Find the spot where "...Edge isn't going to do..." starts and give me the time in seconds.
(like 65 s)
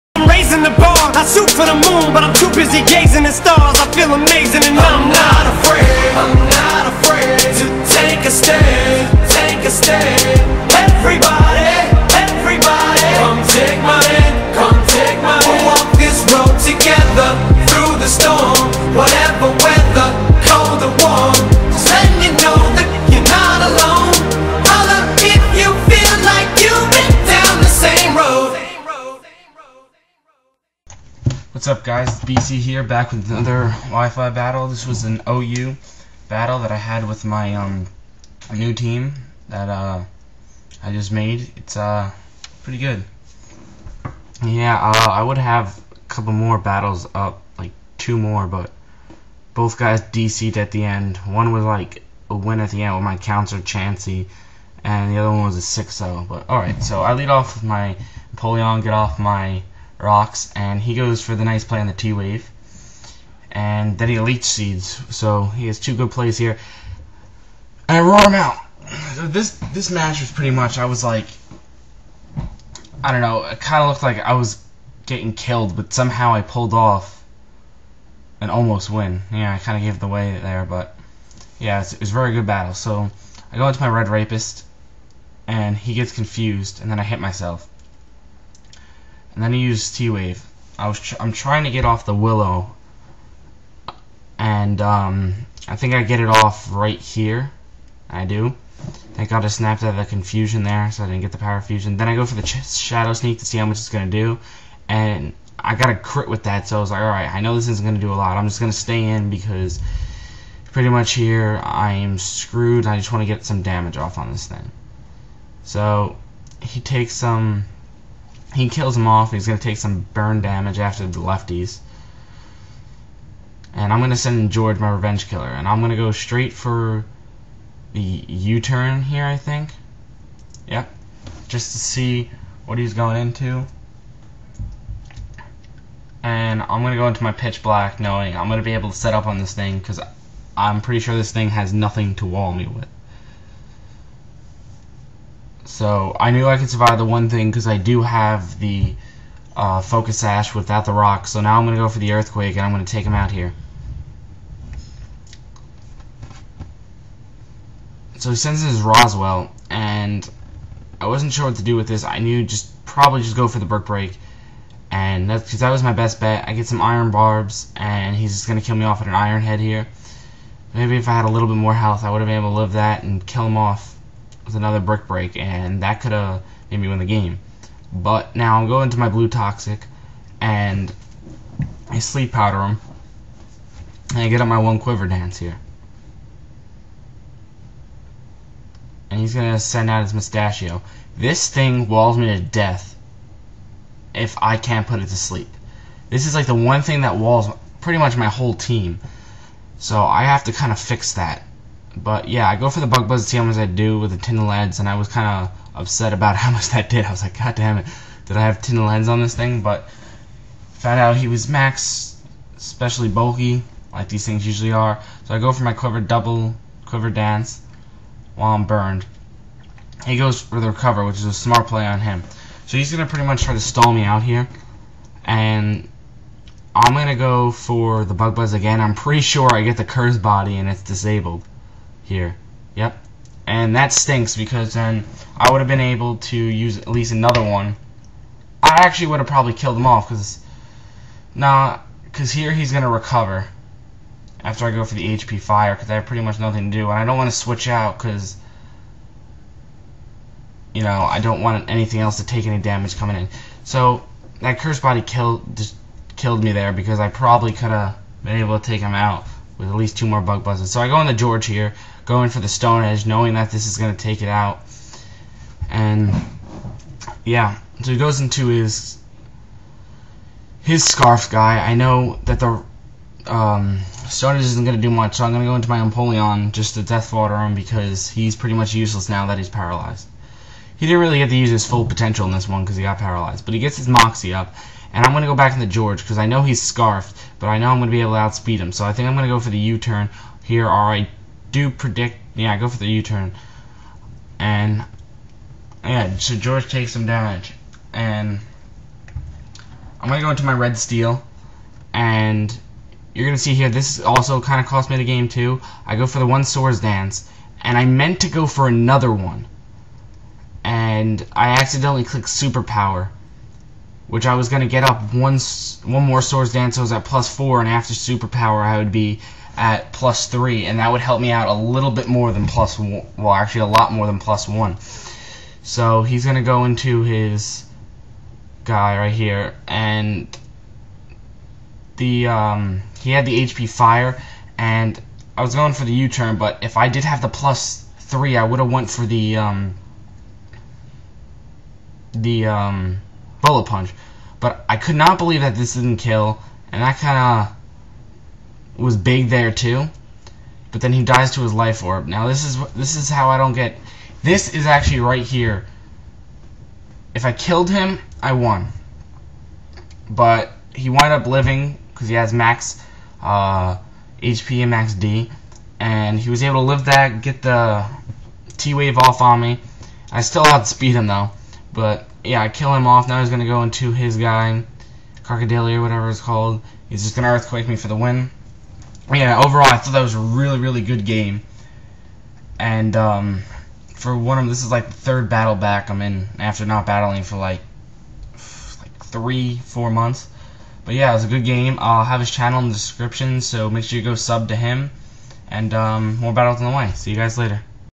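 274 s.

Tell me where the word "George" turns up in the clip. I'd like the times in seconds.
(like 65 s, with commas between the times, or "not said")
124 s, 261 s, 285 s, 296 s.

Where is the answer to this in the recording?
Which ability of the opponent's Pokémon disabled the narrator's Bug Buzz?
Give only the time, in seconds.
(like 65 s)
229 s.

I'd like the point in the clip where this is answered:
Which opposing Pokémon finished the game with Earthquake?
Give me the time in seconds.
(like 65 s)
375 s.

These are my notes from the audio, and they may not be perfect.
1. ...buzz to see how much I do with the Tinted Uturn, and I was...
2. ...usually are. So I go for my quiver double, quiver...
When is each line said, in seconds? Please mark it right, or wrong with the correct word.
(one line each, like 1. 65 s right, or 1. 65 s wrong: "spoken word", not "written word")
1. 203 s wrong: "Lens", not "Uturn"
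2. 214 s right.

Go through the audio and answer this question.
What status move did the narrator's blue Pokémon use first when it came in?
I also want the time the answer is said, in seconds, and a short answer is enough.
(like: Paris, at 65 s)
Sleep Powder, at 181 s.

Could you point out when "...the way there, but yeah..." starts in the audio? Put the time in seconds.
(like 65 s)
79 s.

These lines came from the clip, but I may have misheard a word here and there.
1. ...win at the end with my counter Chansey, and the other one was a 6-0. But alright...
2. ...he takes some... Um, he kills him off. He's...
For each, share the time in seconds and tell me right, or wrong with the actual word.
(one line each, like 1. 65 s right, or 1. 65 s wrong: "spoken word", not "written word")
1. 52 s right
2. 116 s right.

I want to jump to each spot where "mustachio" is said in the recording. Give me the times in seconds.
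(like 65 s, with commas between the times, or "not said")
190 s.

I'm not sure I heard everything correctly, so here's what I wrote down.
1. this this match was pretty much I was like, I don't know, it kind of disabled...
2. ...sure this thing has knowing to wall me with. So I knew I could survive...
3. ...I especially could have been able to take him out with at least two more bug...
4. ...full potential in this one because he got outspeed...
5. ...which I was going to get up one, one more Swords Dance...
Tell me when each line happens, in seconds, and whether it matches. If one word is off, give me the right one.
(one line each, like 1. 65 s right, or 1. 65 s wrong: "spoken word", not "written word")
1. 69 s wrong: "looked", not "disabled"
2. 140 s wrong: "nothing", not "knowing"
3. 256 s wrong: "probably", not "especially"
4. 281 s wrong: "paralyzed", not "outspeed"
5. 314 s right.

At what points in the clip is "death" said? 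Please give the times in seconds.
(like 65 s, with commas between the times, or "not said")
192 s, 276 s.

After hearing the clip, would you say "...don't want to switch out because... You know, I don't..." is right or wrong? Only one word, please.
right.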